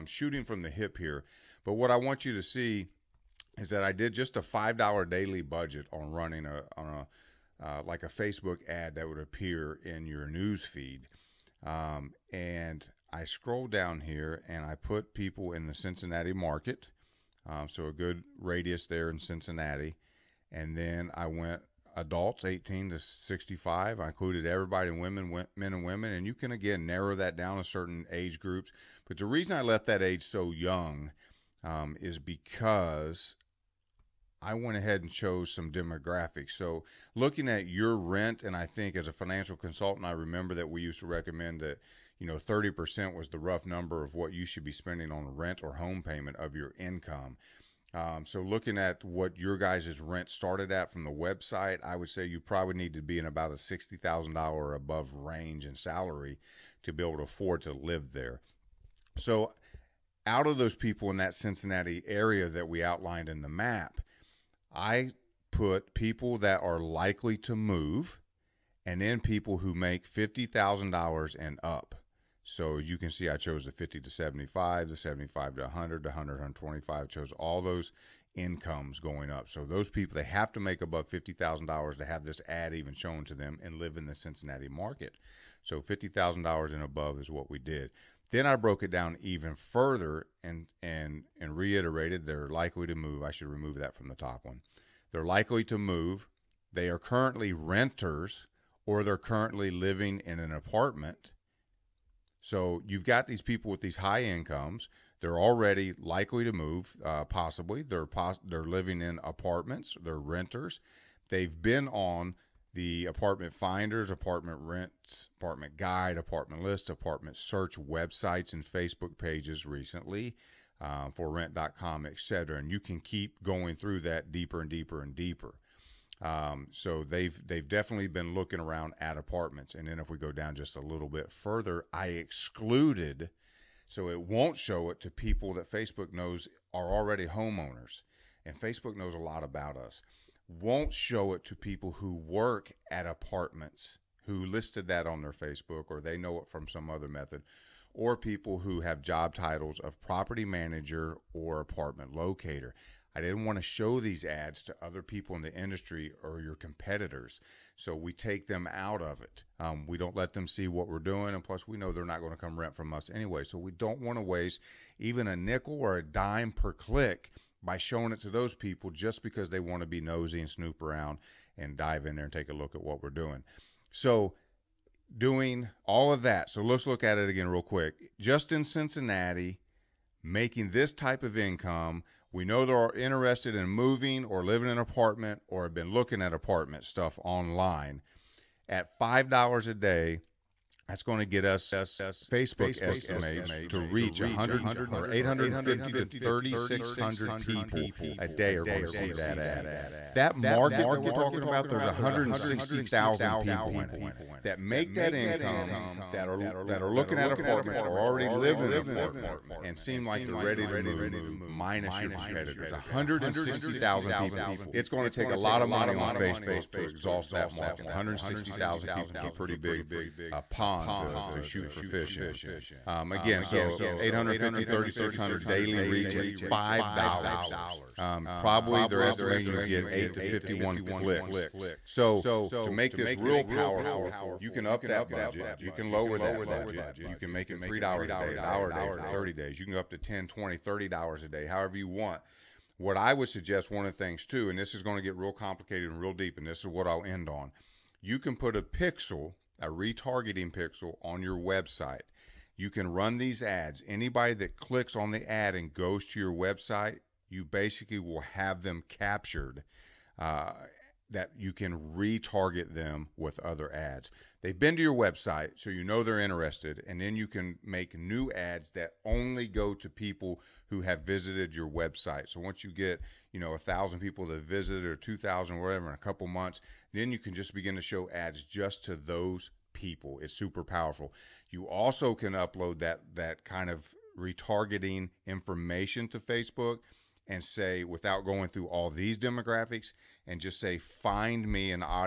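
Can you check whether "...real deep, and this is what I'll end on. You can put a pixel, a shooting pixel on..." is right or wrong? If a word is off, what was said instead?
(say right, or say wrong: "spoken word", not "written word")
wrong: "retargeting", not "shooting".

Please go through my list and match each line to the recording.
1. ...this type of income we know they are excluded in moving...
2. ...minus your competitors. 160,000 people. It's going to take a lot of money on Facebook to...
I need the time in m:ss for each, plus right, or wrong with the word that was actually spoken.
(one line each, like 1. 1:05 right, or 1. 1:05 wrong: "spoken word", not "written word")
1. 3:00 wrong: "interested", not "excluded"
2. 3:31 right.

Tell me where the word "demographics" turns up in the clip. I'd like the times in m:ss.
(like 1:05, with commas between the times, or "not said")
0:35, 4:49.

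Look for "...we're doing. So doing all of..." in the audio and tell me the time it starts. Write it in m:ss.
2:53.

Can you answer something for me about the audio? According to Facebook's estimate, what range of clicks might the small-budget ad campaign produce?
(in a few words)
8 to 51.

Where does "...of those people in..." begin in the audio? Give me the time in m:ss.
1:00.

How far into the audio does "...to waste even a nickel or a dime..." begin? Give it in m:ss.
2:44.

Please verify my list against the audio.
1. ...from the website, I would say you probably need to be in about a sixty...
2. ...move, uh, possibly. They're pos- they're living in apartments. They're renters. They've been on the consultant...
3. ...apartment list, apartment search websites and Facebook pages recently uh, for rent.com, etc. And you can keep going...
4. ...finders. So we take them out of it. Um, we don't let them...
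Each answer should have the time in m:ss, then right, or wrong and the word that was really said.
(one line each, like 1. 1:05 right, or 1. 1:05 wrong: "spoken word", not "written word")
1. 0:50 right
2. 1:46 wrong: "apartment", not "consultant"
3. 1:56 right
4. 2:36 wrong: "competitors", not "finders".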